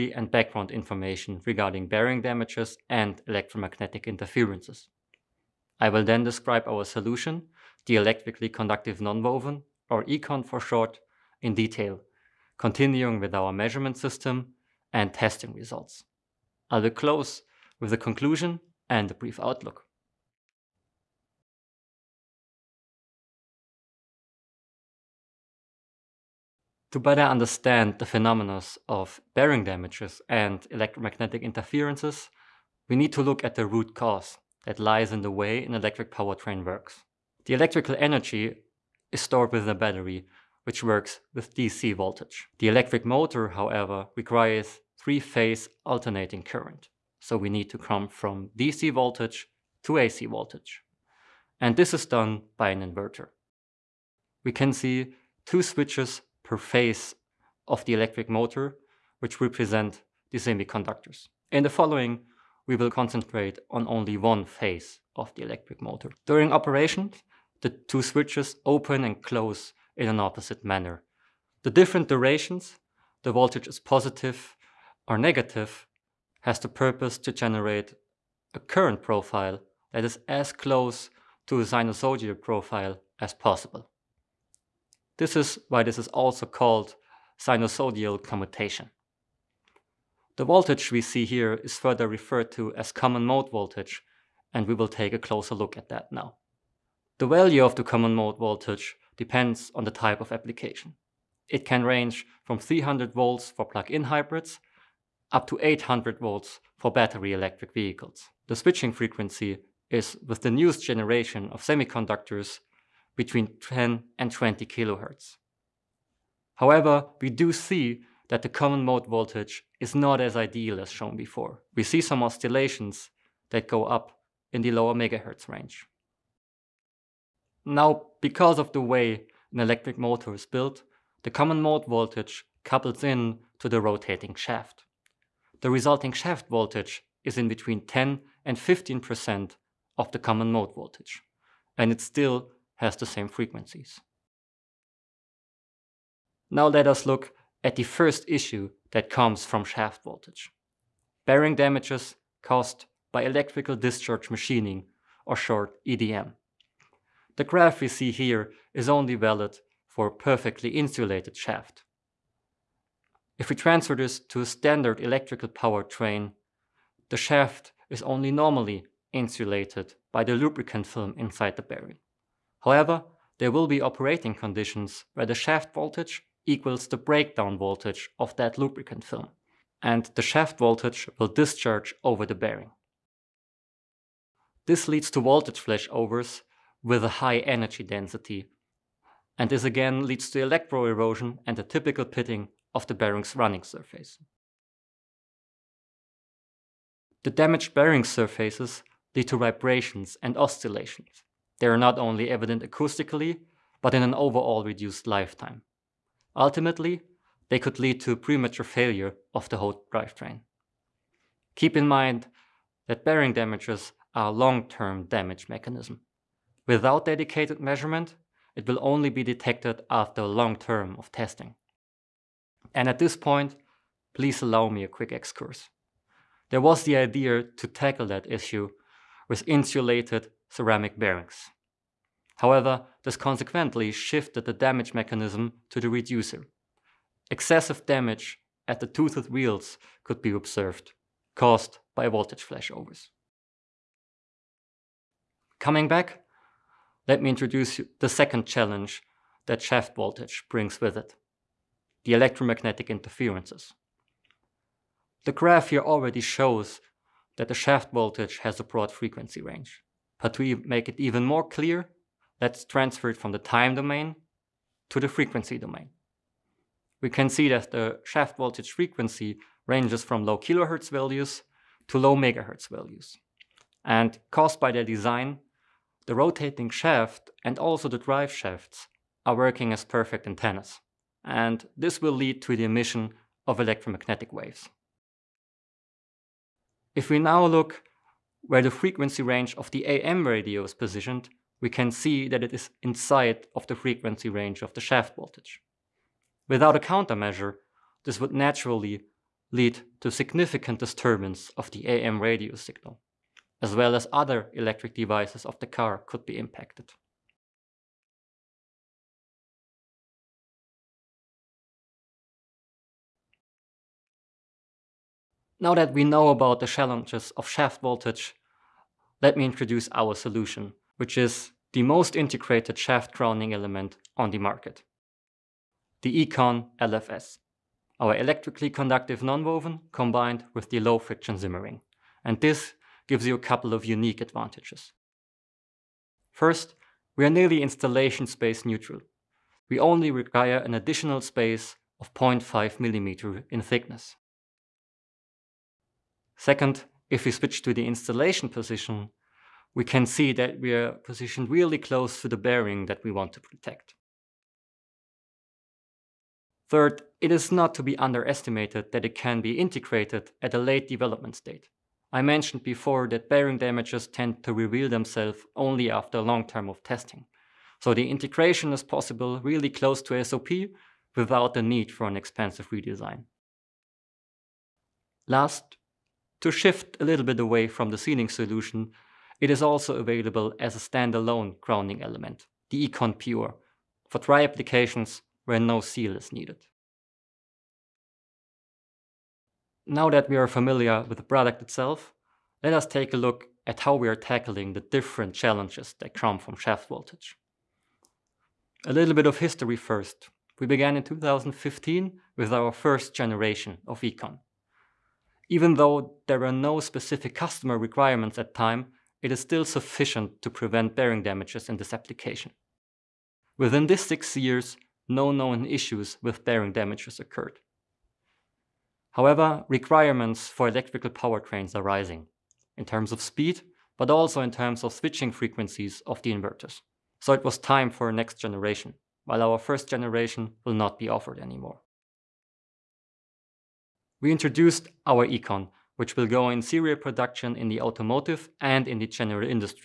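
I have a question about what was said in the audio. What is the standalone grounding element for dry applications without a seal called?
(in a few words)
Econ Pure.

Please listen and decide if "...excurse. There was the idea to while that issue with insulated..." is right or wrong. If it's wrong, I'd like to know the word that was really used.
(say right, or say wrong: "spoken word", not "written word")
wrong: "tackle", not "while".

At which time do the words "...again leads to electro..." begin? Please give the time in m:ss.
3:09.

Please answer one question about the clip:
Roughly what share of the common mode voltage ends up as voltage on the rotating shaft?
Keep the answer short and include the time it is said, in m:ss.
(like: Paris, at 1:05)
10 to 15%, at 2:17.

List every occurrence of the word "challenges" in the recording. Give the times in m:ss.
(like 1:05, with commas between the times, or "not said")
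4:08, 5:16, 6:35.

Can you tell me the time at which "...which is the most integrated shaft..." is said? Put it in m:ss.
5:20.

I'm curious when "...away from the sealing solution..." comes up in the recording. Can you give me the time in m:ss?
6:17.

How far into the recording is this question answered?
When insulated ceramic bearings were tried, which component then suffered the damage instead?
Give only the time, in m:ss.
3:55.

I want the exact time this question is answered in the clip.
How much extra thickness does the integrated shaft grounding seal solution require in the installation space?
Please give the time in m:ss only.
5:42.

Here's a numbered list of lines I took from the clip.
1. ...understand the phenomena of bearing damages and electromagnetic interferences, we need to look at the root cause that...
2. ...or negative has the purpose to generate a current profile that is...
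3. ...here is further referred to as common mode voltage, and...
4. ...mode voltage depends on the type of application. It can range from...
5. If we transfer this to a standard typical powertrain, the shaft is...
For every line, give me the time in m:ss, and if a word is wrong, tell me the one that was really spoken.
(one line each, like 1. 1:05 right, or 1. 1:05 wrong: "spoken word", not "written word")
1. 0:27 right
2. 1:15 right
3. 1:31 right
4. 1:38 right
5. 2:43 wrong: "electrical", not "typical".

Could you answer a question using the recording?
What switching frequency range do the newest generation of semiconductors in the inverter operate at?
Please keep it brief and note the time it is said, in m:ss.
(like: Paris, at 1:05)
10 to 20 kilohertz, at 1:53.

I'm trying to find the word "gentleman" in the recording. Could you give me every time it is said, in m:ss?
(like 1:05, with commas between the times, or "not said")
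not said.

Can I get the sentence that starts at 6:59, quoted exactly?
However, requirements for electrical powertrains are rising, in terms of speed, but also in terms of switching frequencies of the inverters.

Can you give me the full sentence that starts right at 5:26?
The Econ LFS, our electrically conductive nonwoven combined with the low friction Simmerring.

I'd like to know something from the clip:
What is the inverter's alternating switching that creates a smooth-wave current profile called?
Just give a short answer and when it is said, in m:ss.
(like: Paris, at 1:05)
sinusoidal commutation, at 1:27.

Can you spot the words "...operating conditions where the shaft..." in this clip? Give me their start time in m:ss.
2:53.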